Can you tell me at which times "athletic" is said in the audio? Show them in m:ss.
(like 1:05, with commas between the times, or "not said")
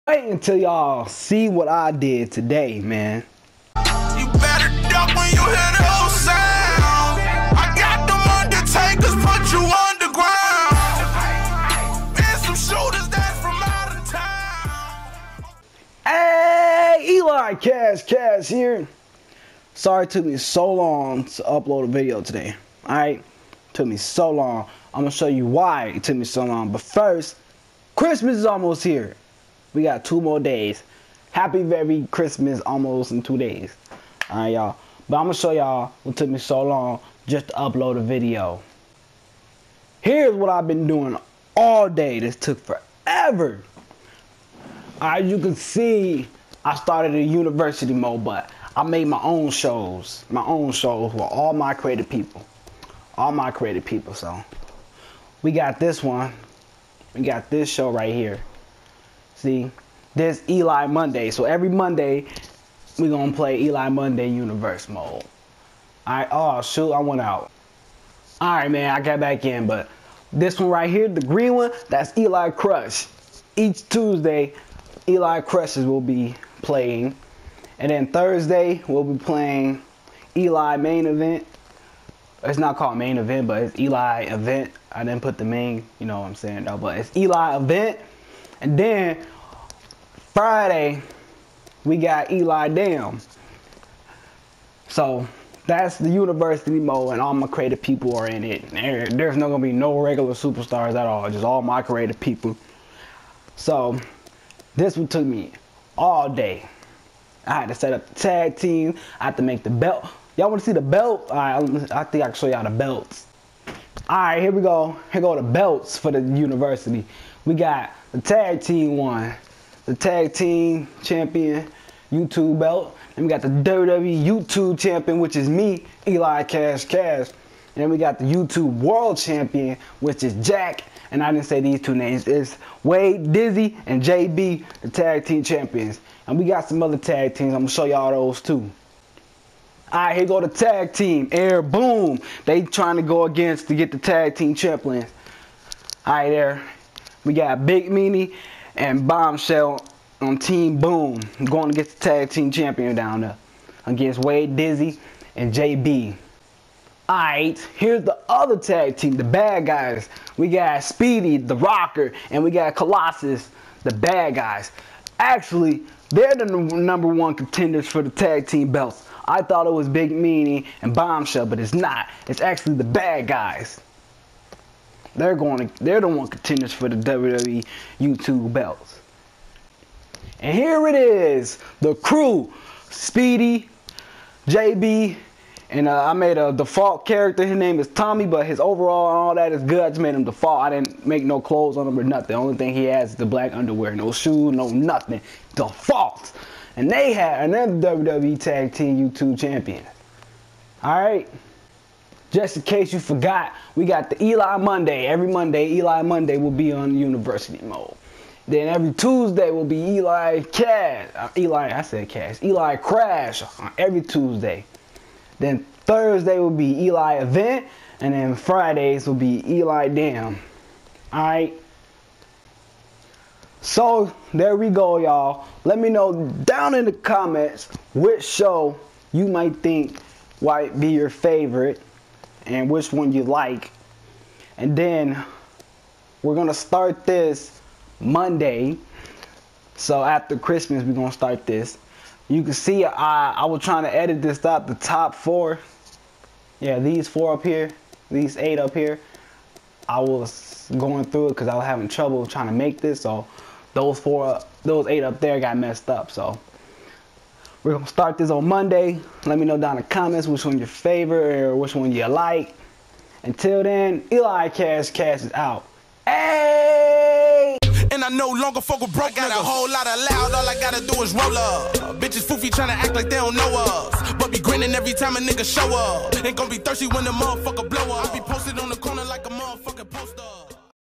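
not said.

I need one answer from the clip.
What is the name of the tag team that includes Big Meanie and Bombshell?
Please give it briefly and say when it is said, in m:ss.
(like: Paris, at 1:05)
Team Boom, at 2:30.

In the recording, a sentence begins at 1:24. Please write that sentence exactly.
I didn't put the main, you know what I'm saying, though, but it's Eli Event.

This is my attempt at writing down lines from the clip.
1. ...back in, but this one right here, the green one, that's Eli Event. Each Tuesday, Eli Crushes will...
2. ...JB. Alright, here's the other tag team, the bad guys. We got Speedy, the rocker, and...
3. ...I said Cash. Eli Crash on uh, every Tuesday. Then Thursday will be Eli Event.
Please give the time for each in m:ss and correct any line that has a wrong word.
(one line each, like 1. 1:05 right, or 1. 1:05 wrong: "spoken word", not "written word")
1. 1:09 wrong: "Crush", not "Event"
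2. 2:35 right
3. 3:31 right.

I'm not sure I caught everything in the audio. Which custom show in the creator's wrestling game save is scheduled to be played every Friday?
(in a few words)
Eli Dam.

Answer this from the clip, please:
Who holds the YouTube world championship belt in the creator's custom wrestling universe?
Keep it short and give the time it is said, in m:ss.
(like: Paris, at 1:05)
Jack, at 2:10.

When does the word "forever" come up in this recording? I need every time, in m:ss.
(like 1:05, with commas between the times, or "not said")
0:42.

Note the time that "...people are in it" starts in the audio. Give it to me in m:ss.
1:37.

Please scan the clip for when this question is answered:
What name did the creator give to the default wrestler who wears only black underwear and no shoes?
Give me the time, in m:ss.
3:07.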